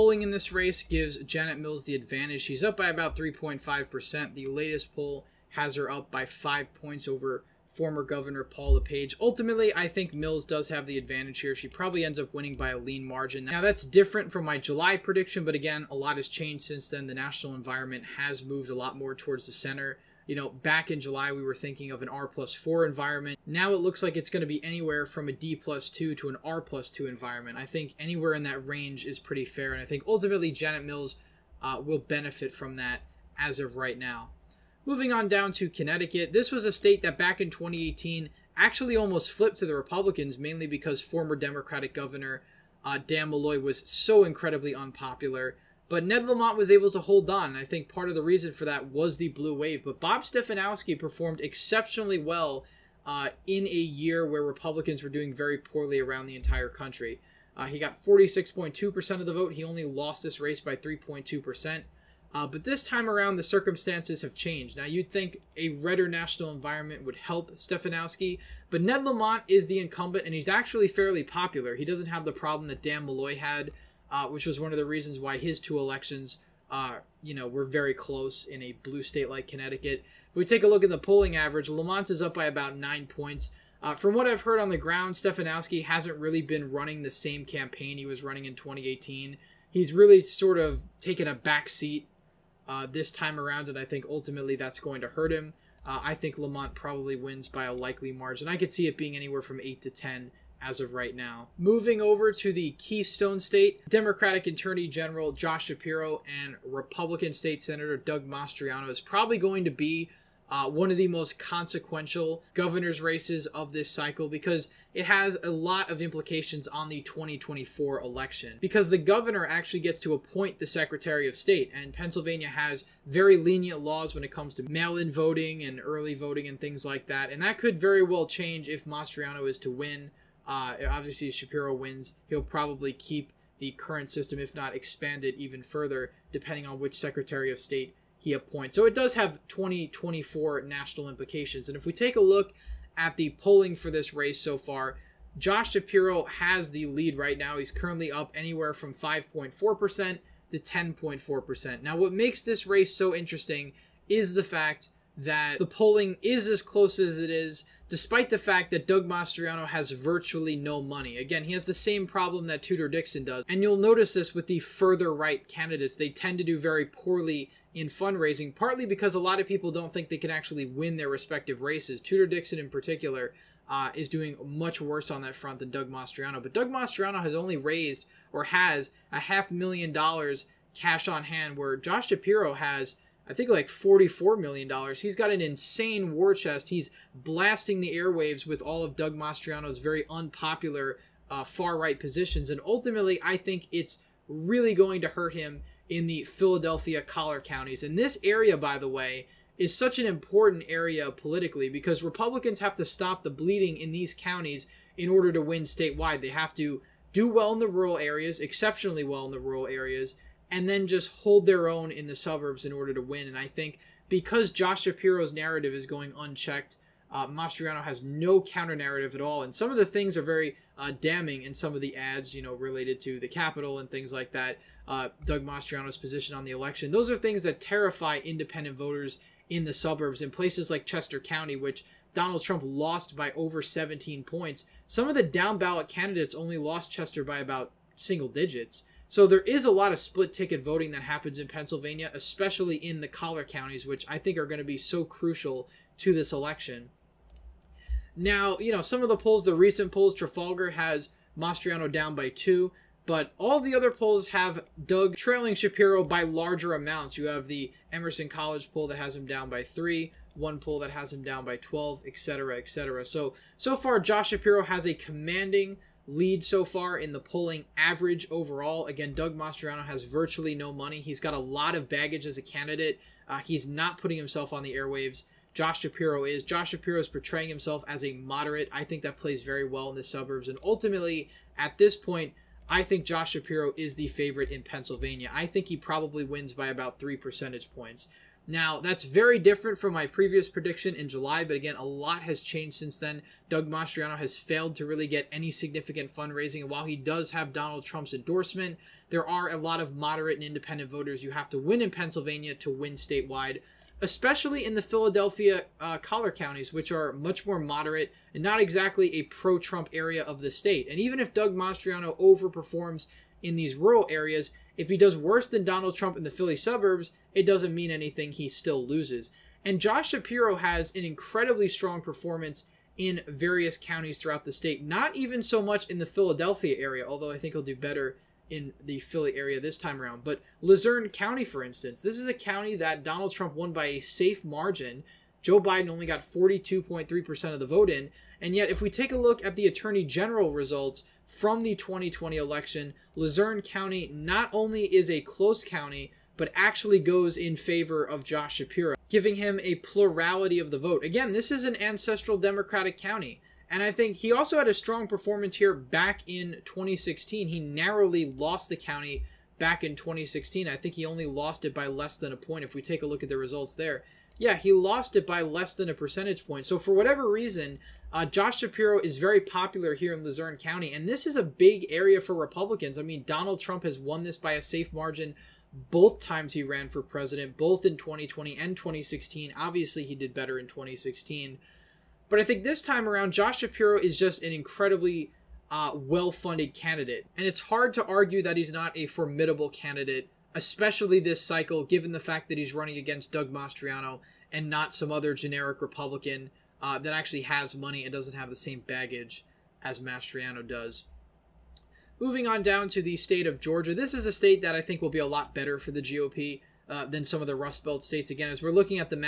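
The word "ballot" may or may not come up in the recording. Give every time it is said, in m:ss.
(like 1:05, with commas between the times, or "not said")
3:55.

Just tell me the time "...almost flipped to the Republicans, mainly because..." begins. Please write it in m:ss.
0:38.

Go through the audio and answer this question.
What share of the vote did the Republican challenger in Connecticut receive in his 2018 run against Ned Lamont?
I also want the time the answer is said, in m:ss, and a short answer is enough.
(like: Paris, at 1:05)
46.2%, at 0:57.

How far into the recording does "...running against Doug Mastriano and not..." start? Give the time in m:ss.
6:32.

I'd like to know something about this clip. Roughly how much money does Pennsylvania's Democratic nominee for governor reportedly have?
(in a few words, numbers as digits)
$44 million.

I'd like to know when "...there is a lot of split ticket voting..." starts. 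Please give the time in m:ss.
3:59.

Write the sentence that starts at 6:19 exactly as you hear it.
Obviously, he did better in 2016.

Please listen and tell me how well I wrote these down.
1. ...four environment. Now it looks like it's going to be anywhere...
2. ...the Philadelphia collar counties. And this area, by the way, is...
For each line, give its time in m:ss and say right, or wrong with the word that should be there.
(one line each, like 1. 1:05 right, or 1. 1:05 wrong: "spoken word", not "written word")
1. 0:22 right
2. 3:16 right.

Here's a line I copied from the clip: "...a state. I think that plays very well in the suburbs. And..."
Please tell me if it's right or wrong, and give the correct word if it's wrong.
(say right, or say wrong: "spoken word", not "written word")
wrong: "moderate", not "state".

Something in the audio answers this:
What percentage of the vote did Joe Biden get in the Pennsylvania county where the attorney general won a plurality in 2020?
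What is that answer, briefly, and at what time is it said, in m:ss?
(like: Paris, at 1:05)
42.3%, at 5:36.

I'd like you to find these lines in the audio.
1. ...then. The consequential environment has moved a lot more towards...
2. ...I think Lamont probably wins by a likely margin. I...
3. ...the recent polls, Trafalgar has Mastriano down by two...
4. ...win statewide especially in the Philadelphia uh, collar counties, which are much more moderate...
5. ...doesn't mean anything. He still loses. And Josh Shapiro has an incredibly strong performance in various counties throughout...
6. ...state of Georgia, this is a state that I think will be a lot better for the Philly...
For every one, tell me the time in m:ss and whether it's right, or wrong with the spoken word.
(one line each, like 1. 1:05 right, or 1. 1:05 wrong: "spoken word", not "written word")
1. 0:16 wrong: "national", not "consequential"
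2. 1:36 right
3. 4:09 right
4. 5:02 right
5. 5:17 right
6. 6:43 wrong: "GOP", not "Philly".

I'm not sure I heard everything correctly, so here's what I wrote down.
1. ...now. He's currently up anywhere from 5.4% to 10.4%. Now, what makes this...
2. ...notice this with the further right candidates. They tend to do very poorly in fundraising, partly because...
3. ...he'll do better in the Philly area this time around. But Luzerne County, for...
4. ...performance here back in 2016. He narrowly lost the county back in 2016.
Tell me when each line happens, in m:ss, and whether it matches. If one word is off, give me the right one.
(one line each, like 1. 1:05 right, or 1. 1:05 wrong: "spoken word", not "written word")
1. 2:27 right
2. 2:43 right
3. 5:27 right
4. 5:55 right.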